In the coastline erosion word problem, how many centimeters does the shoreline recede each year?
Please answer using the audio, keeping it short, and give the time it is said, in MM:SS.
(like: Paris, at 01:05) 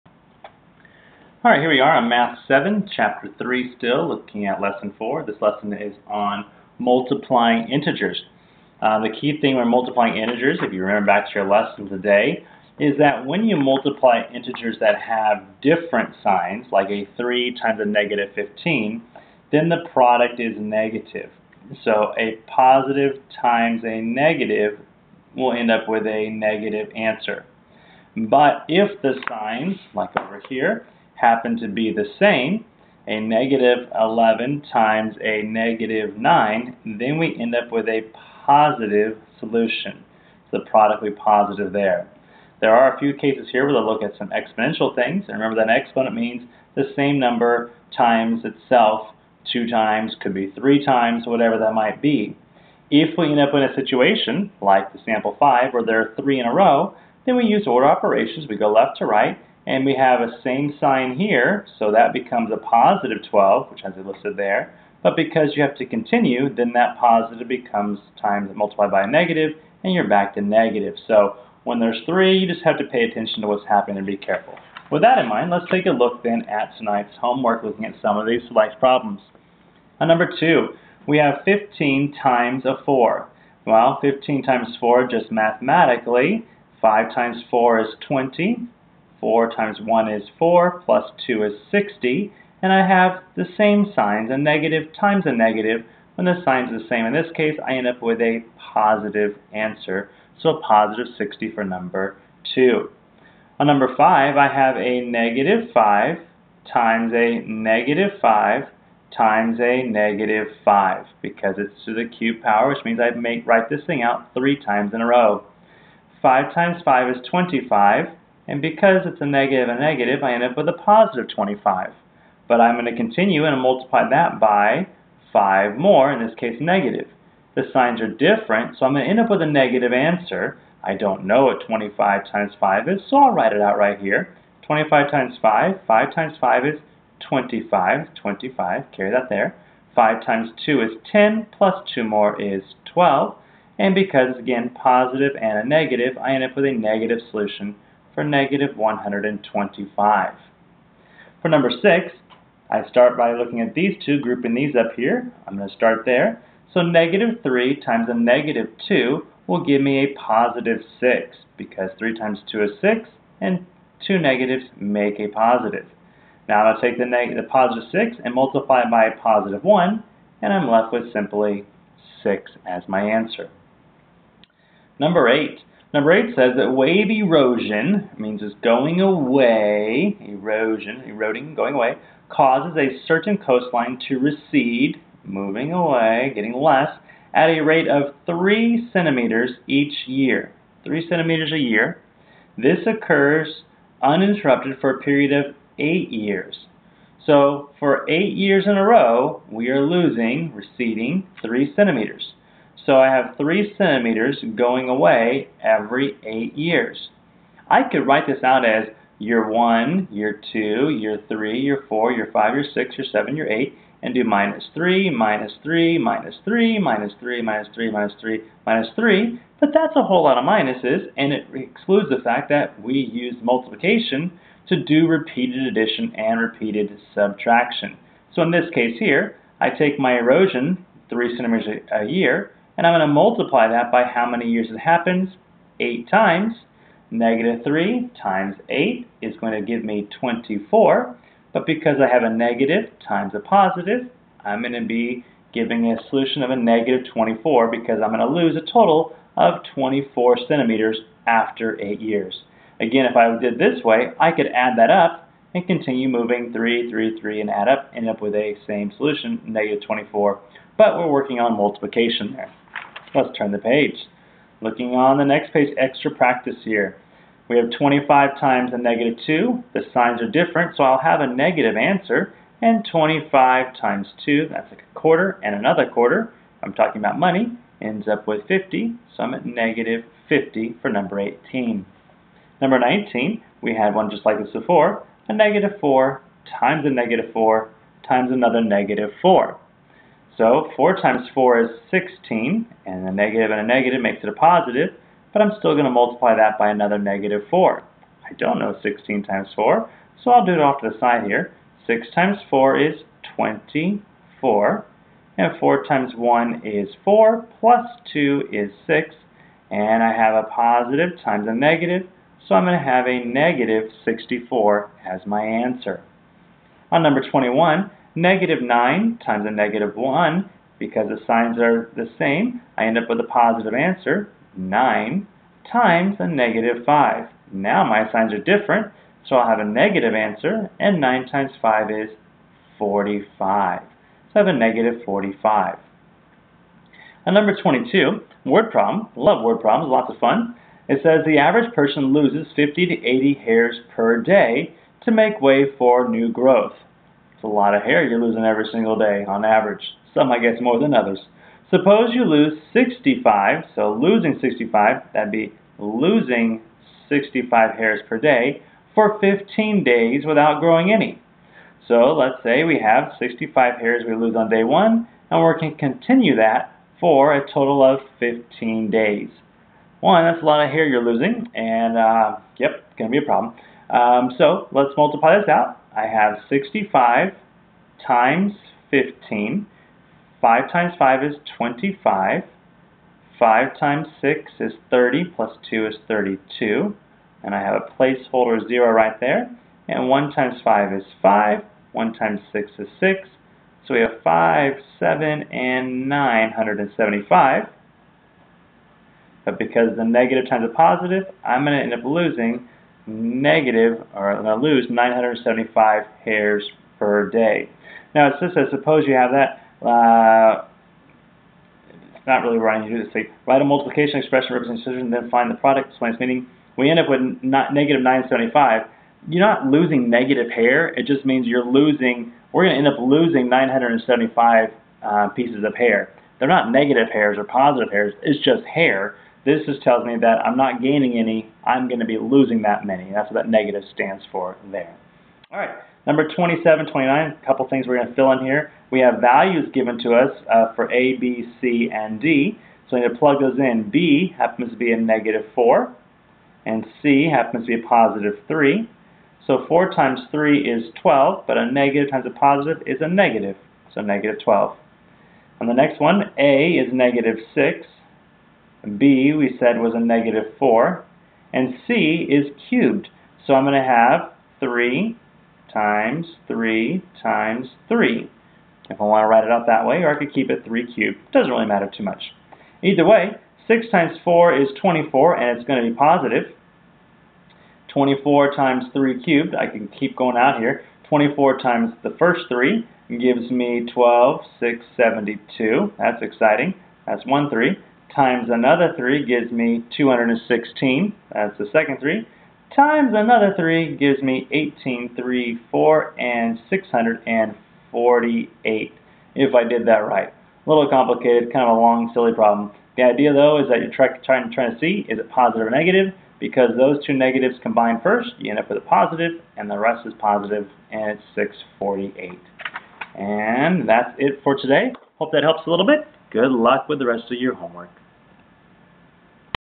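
3 centimeters, at 03:08.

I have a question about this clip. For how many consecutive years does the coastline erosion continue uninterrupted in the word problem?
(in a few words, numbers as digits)
8 years.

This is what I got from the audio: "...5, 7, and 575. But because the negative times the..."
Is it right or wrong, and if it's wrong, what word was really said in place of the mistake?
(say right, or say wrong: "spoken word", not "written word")
wrong: "975", not "575".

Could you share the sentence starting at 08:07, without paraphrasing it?
That's 1 3 times another 3 gives me 216.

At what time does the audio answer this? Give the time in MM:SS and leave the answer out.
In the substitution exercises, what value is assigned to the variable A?
07:36.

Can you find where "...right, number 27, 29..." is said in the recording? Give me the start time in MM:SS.
07:15.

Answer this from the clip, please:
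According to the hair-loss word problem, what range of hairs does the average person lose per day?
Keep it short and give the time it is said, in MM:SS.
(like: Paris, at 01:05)
50 to 80, at 05:42.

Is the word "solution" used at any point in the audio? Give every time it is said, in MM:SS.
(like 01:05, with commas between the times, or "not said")
00:39, 02:27, 04:06, 04:18.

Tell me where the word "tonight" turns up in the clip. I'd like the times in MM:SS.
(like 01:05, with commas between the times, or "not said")
01:16.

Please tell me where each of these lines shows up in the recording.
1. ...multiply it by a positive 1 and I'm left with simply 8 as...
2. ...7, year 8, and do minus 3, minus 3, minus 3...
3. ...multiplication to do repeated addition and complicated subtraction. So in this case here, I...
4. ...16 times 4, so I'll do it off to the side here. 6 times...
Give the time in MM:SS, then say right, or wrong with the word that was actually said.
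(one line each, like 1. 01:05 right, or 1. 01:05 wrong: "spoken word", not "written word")
1. 02:48 wrong: "6", not "8"
2. 03:33 right
3. 03:43 wrong: "repeated", not "complicated"
4. 04:58 right.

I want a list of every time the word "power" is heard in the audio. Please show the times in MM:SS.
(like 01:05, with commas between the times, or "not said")
01:52.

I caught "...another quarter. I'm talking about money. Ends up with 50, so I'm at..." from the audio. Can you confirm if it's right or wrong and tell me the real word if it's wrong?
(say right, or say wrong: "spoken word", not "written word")
right.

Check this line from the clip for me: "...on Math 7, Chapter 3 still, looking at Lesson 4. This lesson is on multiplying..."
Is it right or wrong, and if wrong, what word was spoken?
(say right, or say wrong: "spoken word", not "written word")
right.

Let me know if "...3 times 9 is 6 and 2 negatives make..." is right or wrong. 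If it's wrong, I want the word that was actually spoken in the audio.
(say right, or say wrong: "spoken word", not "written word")
wrong: "2", not "9".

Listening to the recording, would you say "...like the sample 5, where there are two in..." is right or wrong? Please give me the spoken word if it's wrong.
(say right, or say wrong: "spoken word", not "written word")
wrong: "three", not "two".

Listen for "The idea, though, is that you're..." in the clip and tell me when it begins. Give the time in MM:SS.
08:22.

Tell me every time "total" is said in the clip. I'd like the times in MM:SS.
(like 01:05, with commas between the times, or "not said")
04:08, 06:07.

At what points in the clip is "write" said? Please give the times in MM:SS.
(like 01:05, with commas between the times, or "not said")
01:53, 02:13, 03:28, 06:53, 07:49.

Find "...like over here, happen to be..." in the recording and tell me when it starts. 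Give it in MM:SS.
00:29.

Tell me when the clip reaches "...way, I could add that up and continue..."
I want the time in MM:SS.
04:13.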